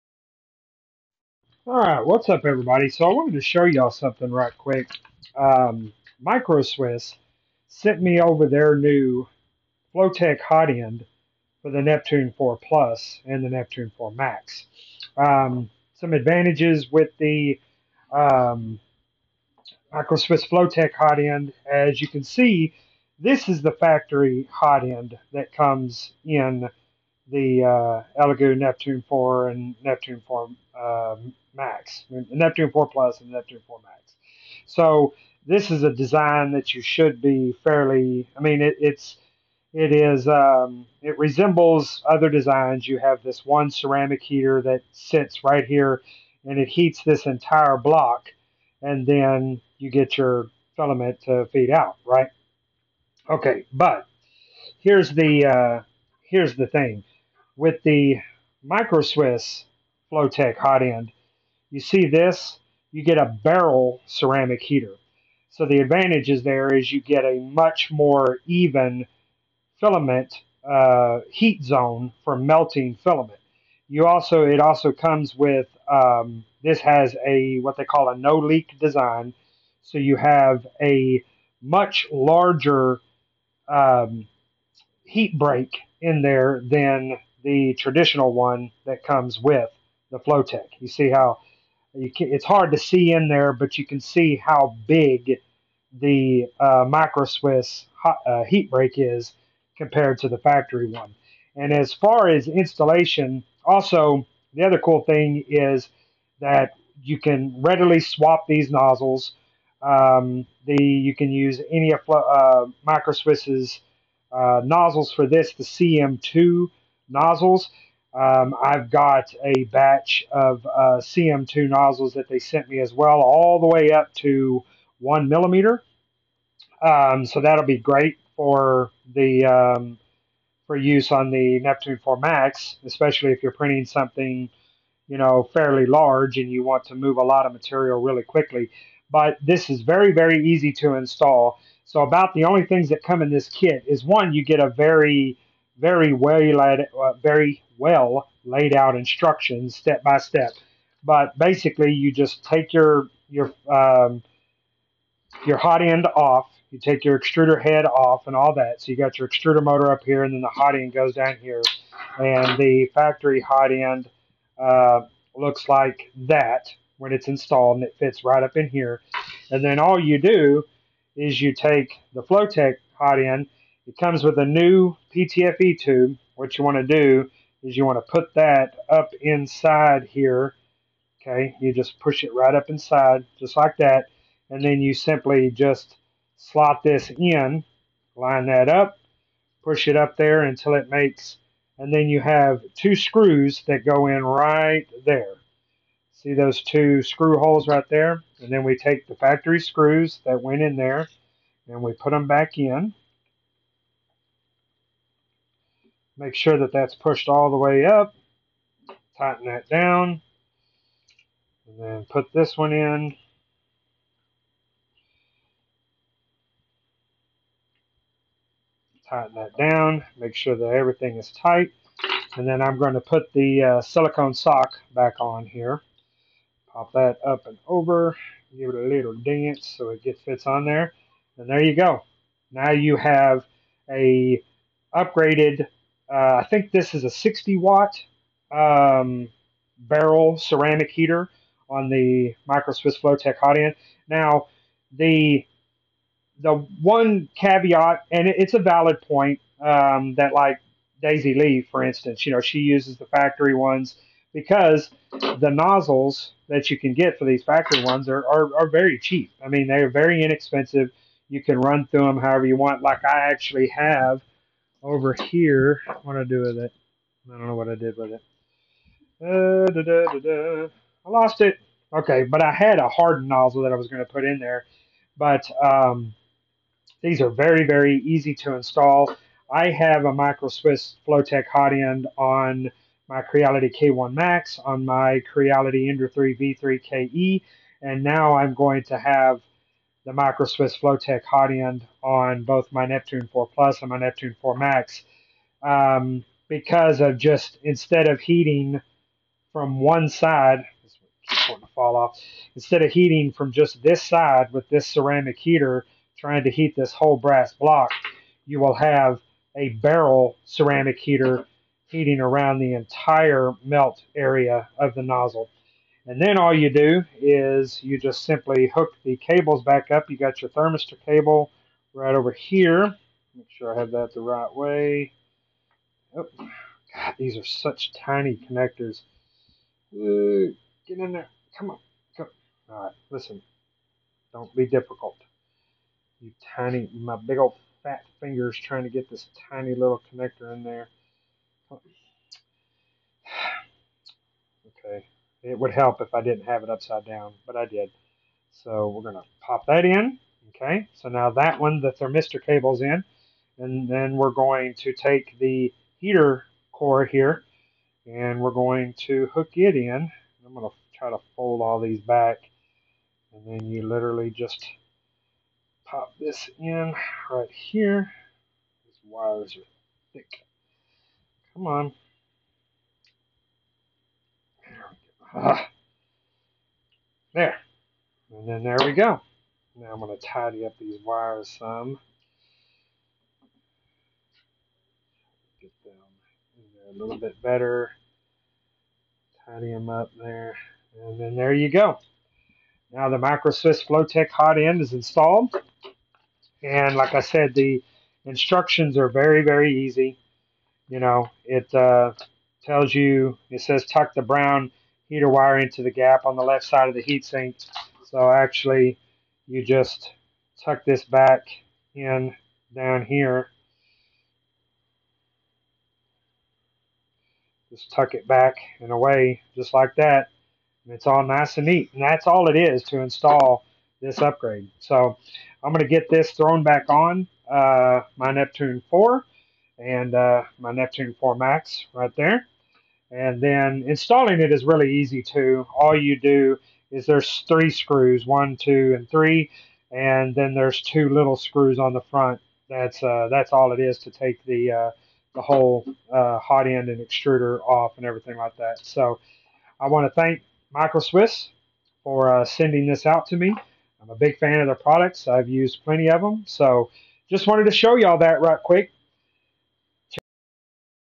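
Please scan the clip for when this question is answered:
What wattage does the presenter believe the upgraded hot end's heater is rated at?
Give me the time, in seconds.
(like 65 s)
237 s.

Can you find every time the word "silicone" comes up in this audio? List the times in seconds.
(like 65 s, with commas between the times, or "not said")
223 s.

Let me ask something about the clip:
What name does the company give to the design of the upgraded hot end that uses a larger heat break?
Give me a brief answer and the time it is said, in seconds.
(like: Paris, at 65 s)
No leak design, at 78 s.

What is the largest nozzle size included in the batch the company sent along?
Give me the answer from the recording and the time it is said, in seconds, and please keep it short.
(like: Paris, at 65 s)
1 millimeter, at 124 s.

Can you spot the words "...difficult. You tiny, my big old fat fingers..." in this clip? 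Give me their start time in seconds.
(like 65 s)
334 s.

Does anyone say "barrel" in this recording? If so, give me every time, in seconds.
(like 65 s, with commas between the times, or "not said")
63 s, 239 s, 309 s.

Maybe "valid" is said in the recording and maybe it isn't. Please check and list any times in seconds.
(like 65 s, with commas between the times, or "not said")
248 s.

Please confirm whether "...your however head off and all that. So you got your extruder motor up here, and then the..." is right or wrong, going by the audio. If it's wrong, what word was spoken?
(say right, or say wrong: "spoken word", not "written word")
wrong: "extruder", not "however".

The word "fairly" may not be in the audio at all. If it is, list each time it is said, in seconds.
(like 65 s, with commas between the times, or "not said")
37 s, 135 s.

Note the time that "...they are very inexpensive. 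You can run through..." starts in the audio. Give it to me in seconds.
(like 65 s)
259 s.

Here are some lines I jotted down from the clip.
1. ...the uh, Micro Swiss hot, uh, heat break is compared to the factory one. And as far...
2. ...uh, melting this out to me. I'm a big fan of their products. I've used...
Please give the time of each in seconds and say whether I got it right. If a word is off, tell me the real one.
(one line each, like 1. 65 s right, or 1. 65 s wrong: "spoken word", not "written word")
1. 95 s right
2. 452 s wrong: "sending", not "melting".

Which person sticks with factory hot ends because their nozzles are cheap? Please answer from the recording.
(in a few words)
Daisy Lee.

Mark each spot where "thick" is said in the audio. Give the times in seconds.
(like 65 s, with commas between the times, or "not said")
370 s.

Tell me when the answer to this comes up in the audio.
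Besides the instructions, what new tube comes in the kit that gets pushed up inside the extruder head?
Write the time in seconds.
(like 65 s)
175 s.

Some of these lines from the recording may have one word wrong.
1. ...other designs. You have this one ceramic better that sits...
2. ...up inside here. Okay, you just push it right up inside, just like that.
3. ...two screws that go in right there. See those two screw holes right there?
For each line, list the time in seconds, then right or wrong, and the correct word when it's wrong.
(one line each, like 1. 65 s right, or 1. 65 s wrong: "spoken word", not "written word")
1. 42 s wrong: "heater", not "better"
2. 178 s right
3. 192 s right.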